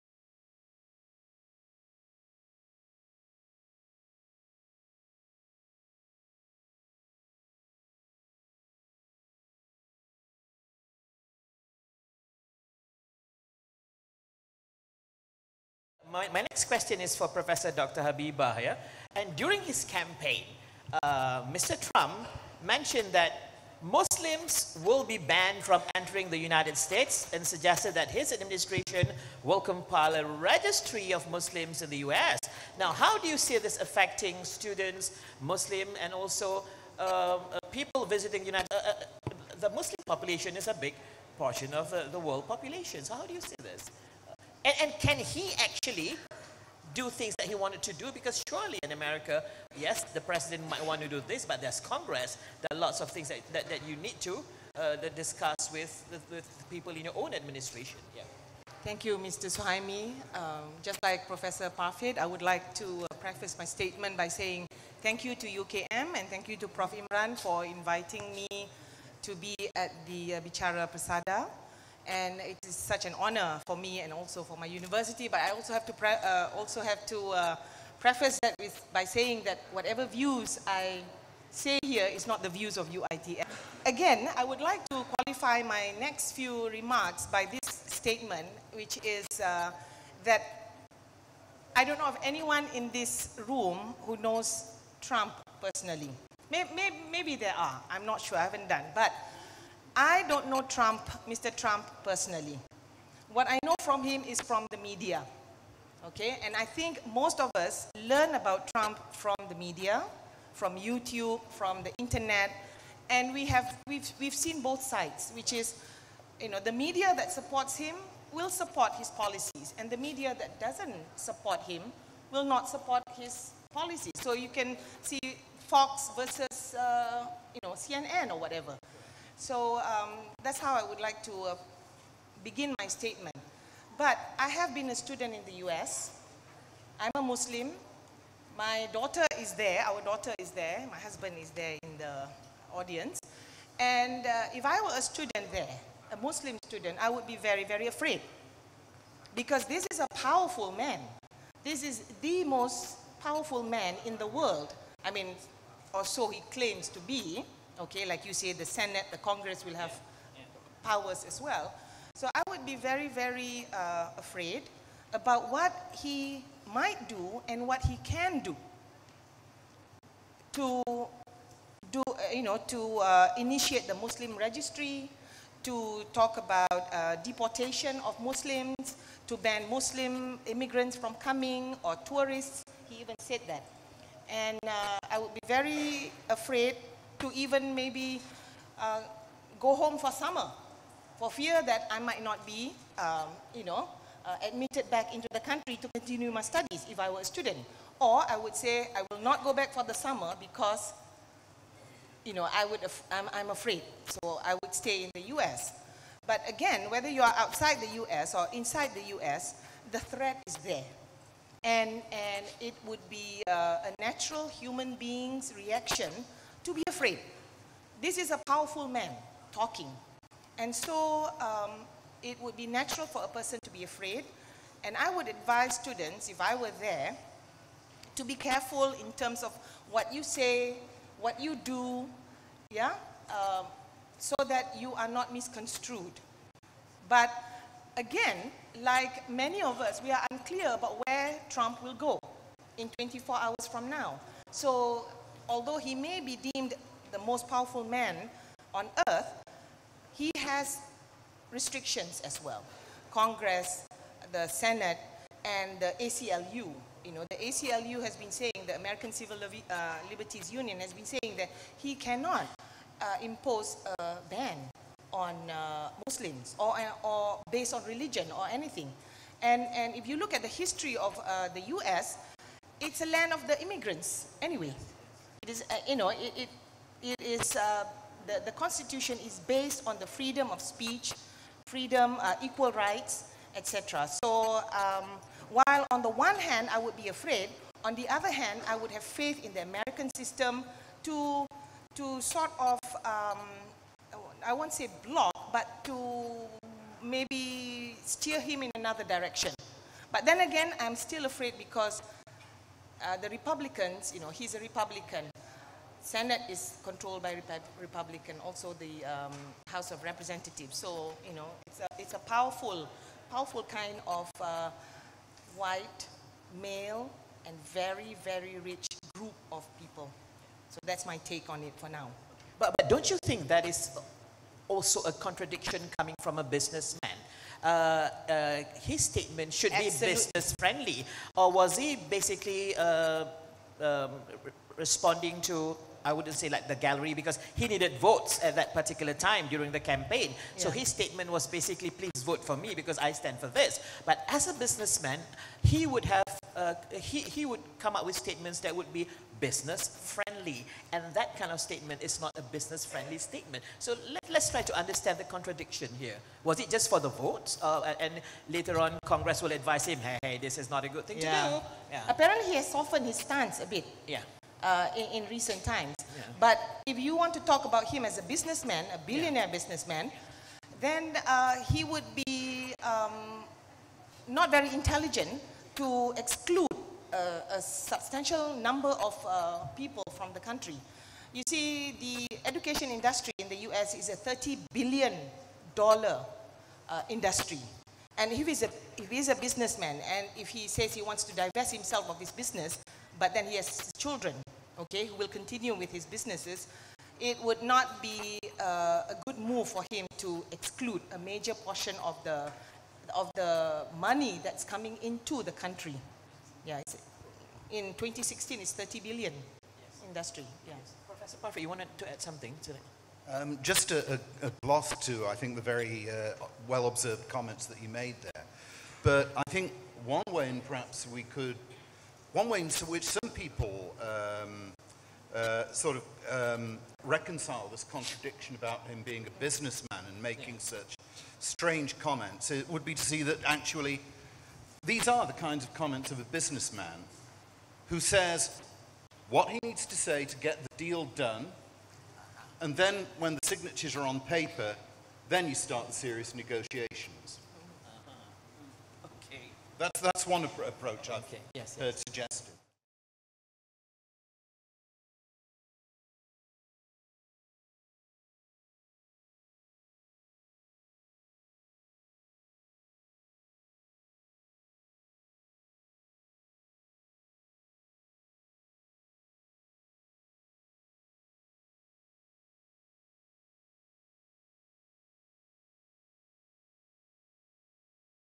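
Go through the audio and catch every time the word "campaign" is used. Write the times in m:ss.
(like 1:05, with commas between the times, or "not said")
0:19, 5:39.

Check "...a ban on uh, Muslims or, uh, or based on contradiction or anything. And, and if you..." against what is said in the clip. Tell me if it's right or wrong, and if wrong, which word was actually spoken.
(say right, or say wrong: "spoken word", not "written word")
wrong: "religion", not "contradiction".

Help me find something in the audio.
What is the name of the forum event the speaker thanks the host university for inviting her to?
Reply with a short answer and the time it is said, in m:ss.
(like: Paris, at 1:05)
Bicara Persada, at 1:10.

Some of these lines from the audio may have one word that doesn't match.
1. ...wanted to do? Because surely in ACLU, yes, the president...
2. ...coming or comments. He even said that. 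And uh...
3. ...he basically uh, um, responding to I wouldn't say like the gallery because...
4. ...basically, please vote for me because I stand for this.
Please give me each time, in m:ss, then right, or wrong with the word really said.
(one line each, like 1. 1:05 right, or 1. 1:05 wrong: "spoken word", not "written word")
1. 0:47 wrong: "America", not "ACLU"
2. 3:01 wrong: "tourists", not "comments"
3. 5:31 right
4. 5:41 right.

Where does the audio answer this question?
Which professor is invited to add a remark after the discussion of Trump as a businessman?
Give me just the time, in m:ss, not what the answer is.
6:51.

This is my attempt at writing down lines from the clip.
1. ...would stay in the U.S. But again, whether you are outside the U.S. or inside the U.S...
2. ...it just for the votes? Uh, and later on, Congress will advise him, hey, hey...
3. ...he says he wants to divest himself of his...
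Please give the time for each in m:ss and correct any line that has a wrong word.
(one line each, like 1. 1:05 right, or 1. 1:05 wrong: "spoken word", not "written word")
1. 3:24 right
2. 5:56 right
3. 6:30 right.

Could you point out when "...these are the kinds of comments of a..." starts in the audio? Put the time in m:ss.
7:14.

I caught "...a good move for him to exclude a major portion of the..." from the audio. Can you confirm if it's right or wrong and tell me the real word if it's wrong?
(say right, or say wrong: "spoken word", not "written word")
right.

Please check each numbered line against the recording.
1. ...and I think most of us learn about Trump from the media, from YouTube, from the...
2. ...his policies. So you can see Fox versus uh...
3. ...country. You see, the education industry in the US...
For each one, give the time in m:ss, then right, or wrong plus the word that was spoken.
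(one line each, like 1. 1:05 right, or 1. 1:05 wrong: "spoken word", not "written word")
1. 1:46 right
2. 2:03 right
3. 6:20 right.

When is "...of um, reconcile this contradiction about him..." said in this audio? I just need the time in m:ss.
7:05.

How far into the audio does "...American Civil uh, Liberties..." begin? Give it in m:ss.
4:18.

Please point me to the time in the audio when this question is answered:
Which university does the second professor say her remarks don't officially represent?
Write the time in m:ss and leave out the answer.
1:22.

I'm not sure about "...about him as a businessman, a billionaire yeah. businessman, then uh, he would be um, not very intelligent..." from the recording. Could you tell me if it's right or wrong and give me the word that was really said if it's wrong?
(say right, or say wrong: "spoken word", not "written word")
right.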